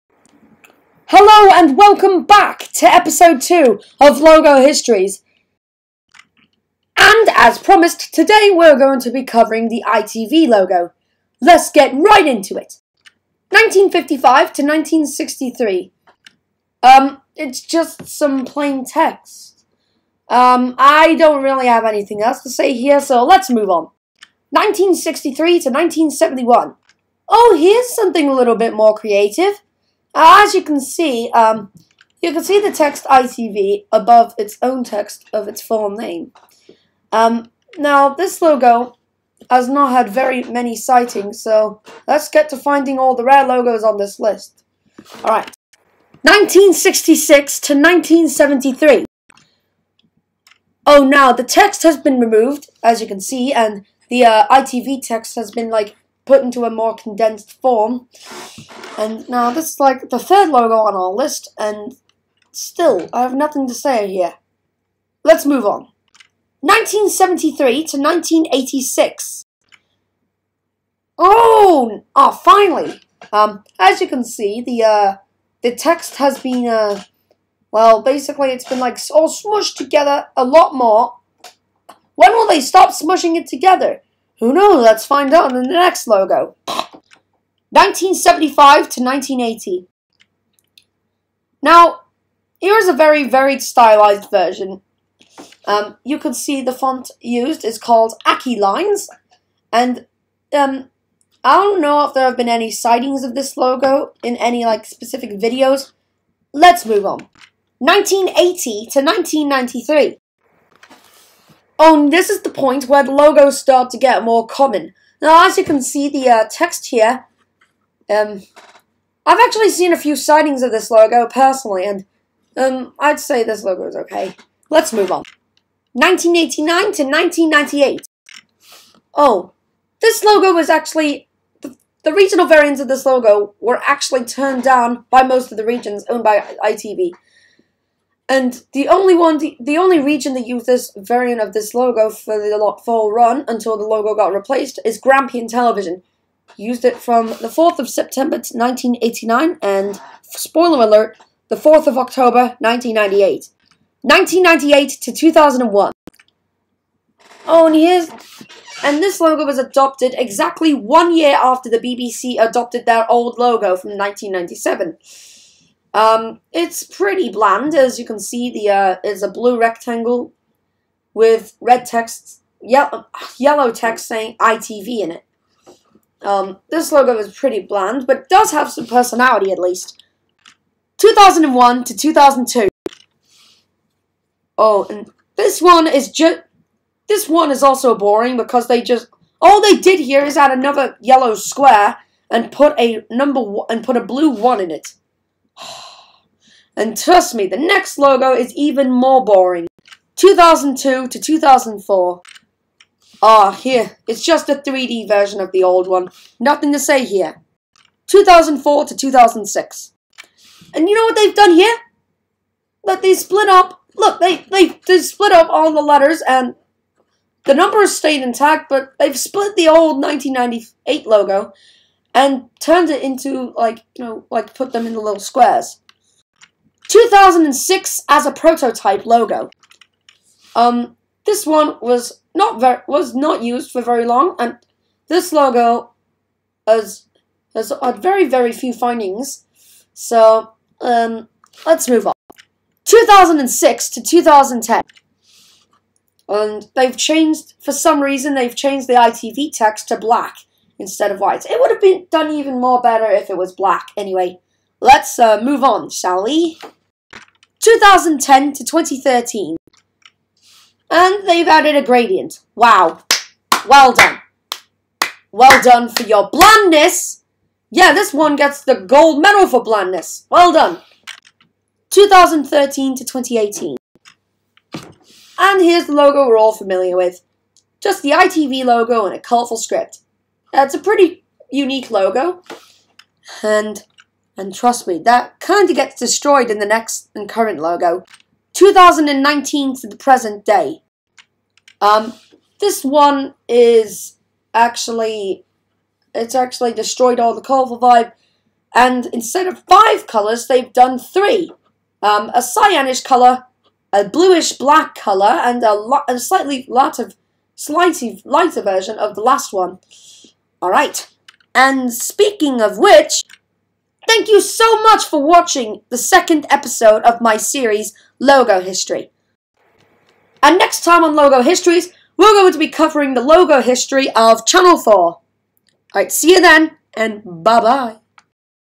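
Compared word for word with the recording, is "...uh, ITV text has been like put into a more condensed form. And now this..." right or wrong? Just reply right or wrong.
right.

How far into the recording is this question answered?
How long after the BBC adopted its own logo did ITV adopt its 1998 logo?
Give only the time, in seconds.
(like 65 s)
160 s.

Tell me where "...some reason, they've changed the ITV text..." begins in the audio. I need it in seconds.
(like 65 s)
247 s.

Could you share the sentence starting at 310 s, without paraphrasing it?
Alright, and speaking of which, thank you so much for watching the second episode of my series, Logo History.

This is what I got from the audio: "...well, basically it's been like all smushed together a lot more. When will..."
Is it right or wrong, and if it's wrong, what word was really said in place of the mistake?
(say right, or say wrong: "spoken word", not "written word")
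right.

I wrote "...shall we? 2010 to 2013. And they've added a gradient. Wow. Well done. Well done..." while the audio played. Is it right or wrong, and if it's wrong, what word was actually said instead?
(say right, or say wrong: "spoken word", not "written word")
right.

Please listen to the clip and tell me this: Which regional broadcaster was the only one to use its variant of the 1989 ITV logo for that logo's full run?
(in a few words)
Grampian Television.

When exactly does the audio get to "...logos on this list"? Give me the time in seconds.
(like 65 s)
43 s.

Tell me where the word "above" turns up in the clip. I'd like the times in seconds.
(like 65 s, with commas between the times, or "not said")
33 s.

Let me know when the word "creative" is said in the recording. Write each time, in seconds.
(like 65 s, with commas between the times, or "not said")
28 s.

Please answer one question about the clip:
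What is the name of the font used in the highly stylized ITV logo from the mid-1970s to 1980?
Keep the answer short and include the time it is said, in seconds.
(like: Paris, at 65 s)
Aki Lines, at 98 s.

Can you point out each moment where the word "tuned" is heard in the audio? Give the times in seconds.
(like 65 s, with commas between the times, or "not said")
not said.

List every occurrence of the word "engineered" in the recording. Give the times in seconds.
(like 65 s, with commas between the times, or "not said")
not said.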